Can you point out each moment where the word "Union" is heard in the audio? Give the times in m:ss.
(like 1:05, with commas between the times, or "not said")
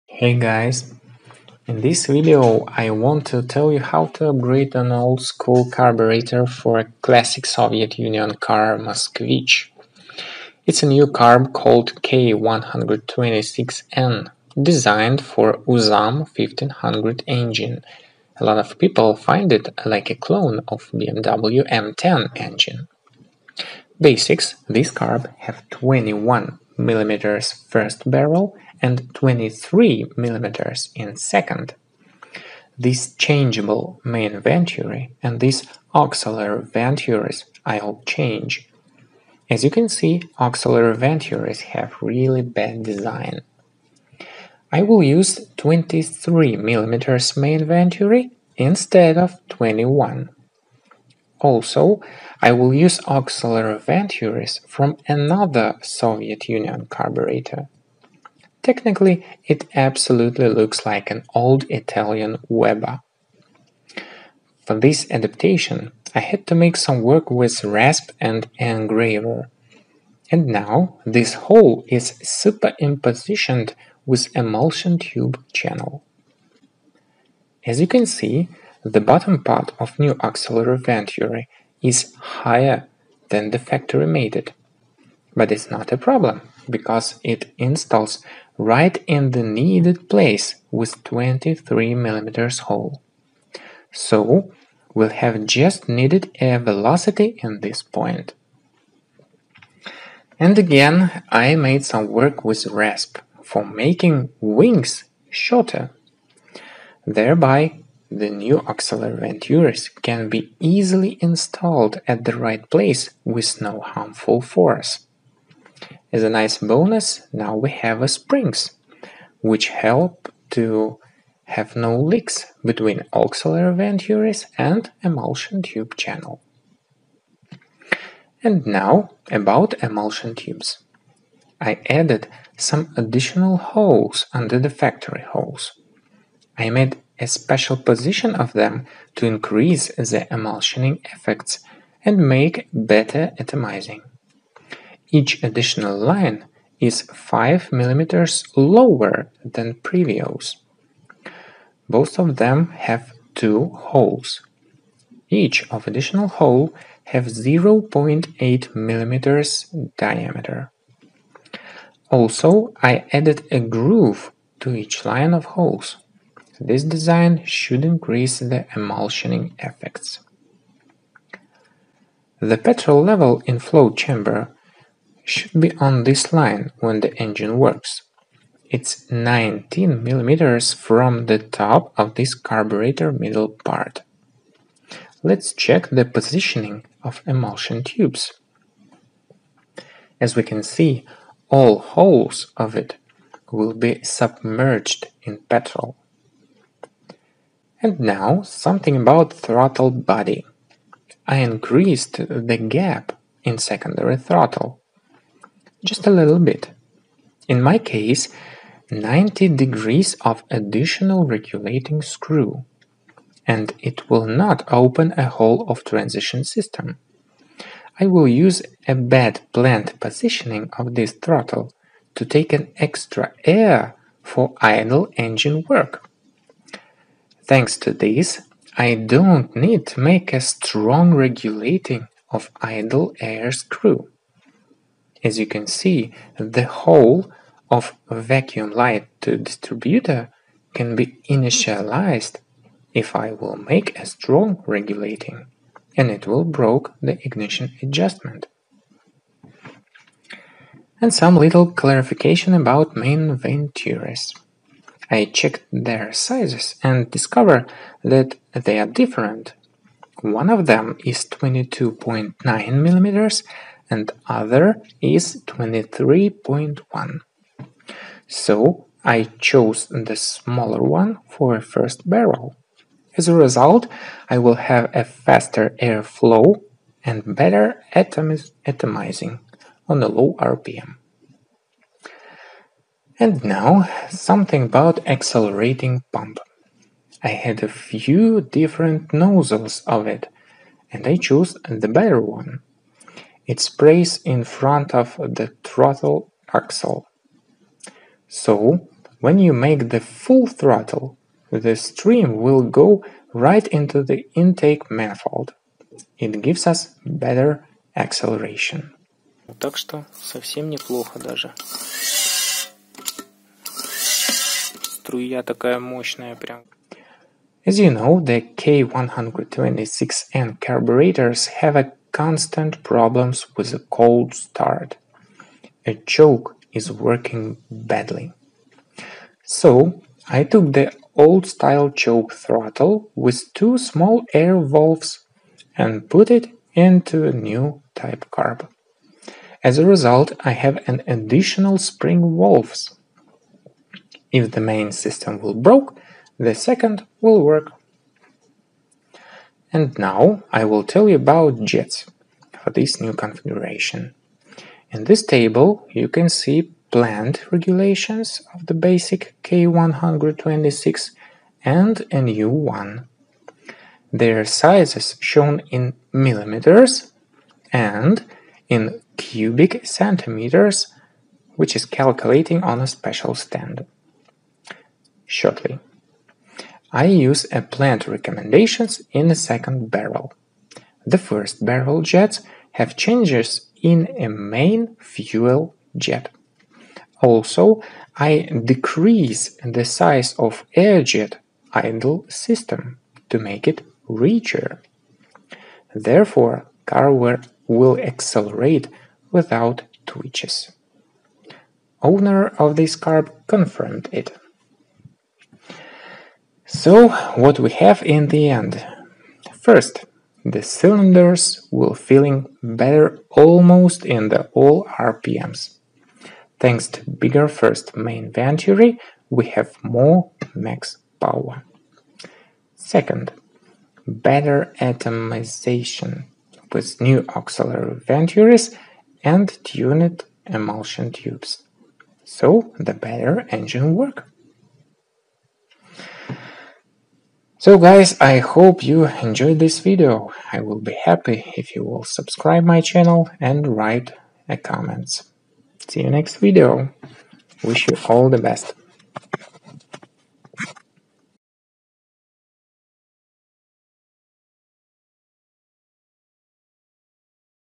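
0:07, 0:56.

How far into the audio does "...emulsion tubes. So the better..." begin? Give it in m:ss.
7:10.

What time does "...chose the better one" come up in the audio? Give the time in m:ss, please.
4:51.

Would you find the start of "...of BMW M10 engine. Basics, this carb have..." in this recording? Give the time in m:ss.
0:20.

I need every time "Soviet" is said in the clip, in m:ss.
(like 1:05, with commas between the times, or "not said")
0:07, 0:55.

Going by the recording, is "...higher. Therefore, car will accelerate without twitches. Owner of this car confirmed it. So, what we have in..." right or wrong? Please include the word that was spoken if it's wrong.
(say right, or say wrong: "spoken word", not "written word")
wrong: "richer", not "higher".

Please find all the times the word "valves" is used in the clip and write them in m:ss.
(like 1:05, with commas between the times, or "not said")
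5:34, 5:42.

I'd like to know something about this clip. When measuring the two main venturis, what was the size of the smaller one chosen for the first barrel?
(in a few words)
22.9 mm.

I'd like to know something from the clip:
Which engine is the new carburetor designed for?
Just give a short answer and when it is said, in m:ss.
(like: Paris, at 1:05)
UZAM 1500, at 0:15.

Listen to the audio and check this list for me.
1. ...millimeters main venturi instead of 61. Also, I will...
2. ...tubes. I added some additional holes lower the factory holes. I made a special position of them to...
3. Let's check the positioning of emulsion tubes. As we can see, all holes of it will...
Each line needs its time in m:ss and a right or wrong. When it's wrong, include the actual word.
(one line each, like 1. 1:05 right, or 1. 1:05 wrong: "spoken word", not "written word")
1. 0:46 wrong: "21", not "61"
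2. 2:10 wrong: "under", not "lower"
3. 3:05 right.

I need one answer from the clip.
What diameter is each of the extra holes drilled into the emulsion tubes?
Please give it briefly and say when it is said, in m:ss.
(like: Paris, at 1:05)
0.8 mm, at 2:37.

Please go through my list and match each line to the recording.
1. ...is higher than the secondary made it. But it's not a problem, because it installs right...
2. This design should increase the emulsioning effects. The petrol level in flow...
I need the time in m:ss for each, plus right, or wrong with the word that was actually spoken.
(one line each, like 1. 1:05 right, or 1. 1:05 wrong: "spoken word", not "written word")
1. 1:21 wrong: "factory", not "secondary"
2. 2:46 right.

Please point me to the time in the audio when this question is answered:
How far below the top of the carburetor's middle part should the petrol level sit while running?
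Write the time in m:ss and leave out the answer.
2:59.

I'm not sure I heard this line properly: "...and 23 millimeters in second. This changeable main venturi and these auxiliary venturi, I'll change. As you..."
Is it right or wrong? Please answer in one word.
right.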